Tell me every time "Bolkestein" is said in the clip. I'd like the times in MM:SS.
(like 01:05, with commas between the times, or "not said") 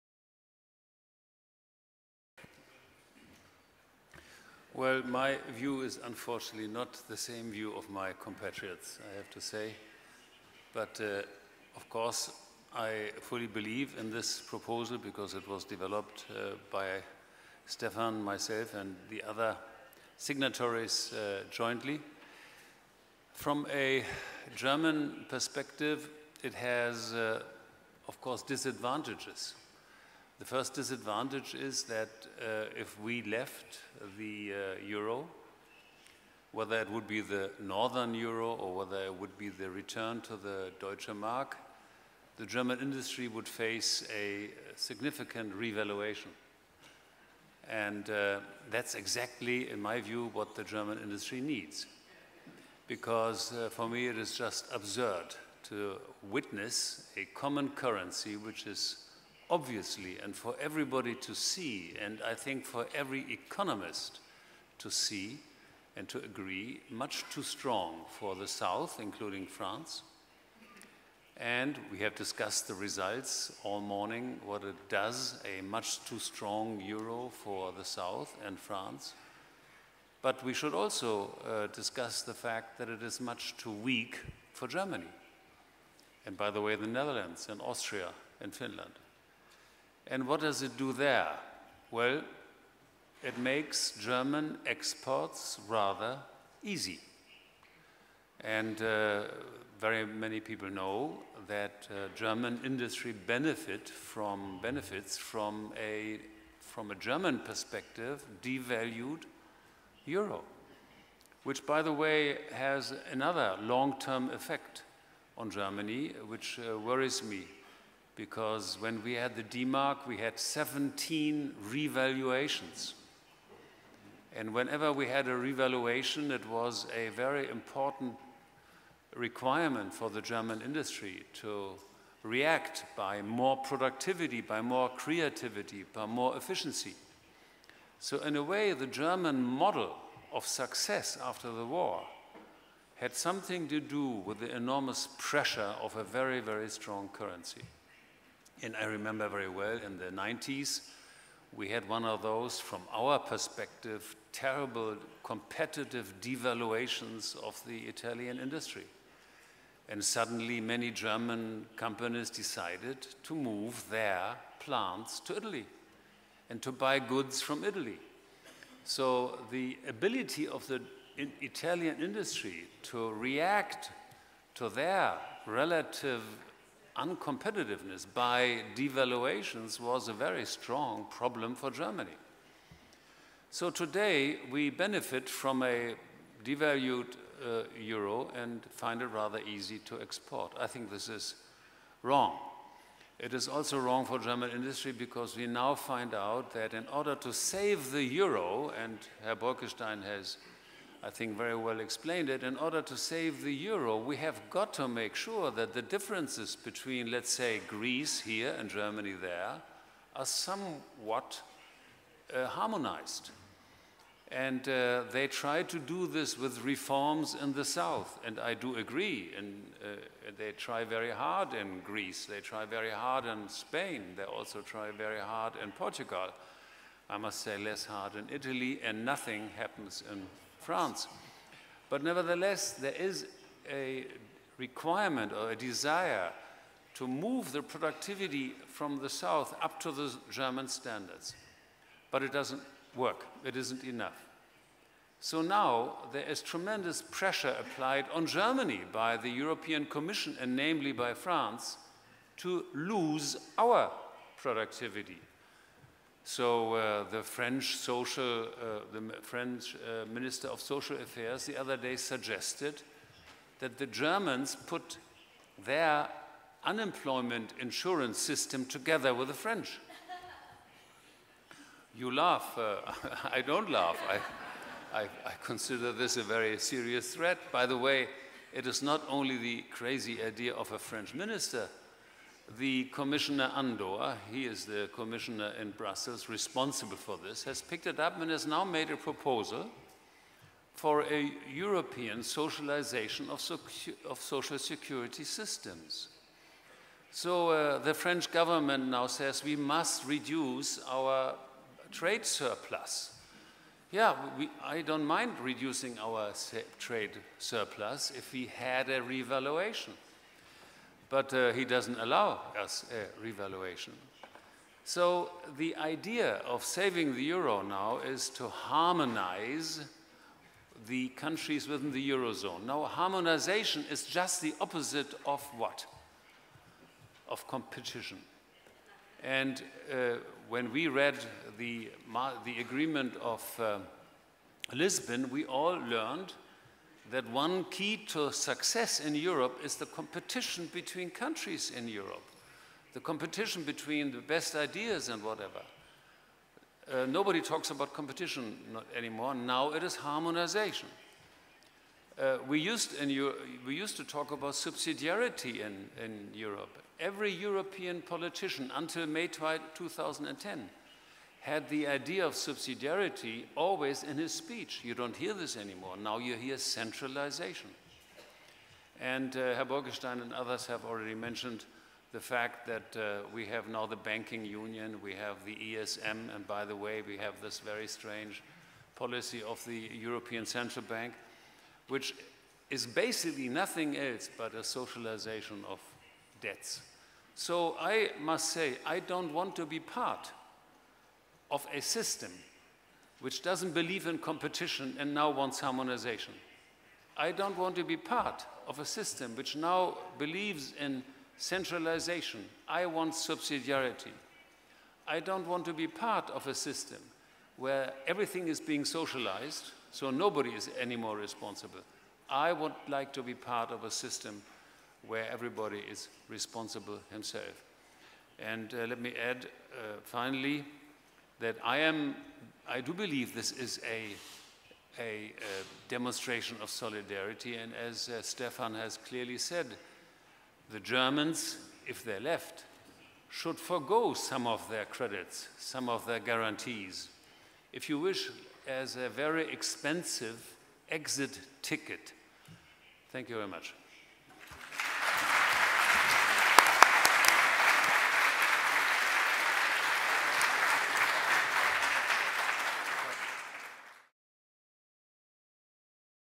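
03:19, 06:09.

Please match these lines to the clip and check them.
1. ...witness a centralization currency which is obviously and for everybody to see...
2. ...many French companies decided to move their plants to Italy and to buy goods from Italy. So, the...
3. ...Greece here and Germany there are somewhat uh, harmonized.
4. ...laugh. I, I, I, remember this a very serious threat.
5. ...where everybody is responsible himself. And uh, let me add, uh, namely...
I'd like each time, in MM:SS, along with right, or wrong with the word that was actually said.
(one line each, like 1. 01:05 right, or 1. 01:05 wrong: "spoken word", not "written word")
1. 00:56 wrong: "common", not "centralization"
2. 02:40 wrong: "German", not "French"
3. 03:27 right
4. 04:33 wrong: "consider", not "remember"
5. 06:55 wrong: "finally", not "namely".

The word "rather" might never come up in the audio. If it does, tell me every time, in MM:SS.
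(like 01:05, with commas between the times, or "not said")
01:35, 03:09.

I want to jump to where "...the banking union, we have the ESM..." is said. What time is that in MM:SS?
06:13.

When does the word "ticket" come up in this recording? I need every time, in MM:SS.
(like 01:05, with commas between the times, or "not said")
07:21.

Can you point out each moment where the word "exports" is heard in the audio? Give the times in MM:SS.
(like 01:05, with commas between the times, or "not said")
01:34, 03:10.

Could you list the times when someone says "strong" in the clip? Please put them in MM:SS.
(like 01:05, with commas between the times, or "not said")
01:07, 01:16, 02:26, 03:00.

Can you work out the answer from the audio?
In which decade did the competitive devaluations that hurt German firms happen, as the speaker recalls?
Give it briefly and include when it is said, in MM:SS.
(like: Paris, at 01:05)
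the 90s, at 02:30.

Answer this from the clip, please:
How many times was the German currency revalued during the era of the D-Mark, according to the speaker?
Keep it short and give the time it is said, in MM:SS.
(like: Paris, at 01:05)
17, at 02:00.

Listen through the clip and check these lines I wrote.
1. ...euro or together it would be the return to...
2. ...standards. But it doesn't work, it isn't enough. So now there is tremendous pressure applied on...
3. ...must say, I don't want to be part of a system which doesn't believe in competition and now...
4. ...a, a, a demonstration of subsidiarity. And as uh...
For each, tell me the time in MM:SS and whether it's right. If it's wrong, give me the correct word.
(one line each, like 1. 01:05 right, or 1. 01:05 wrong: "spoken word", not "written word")
1. 00:38 wrong: "whether", not "together"
2. 04:00 right
3. 06:28 right
4. 07:03 wrong: "solidarity", not "subsidiarity".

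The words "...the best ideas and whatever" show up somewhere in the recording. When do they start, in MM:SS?
05:44.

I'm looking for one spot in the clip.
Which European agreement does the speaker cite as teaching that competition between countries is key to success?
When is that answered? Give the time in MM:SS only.
05:34.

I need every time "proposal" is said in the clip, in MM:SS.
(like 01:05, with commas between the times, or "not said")
00:14, 04:48.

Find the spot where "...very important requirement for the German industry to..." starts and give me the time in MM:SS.
02:07.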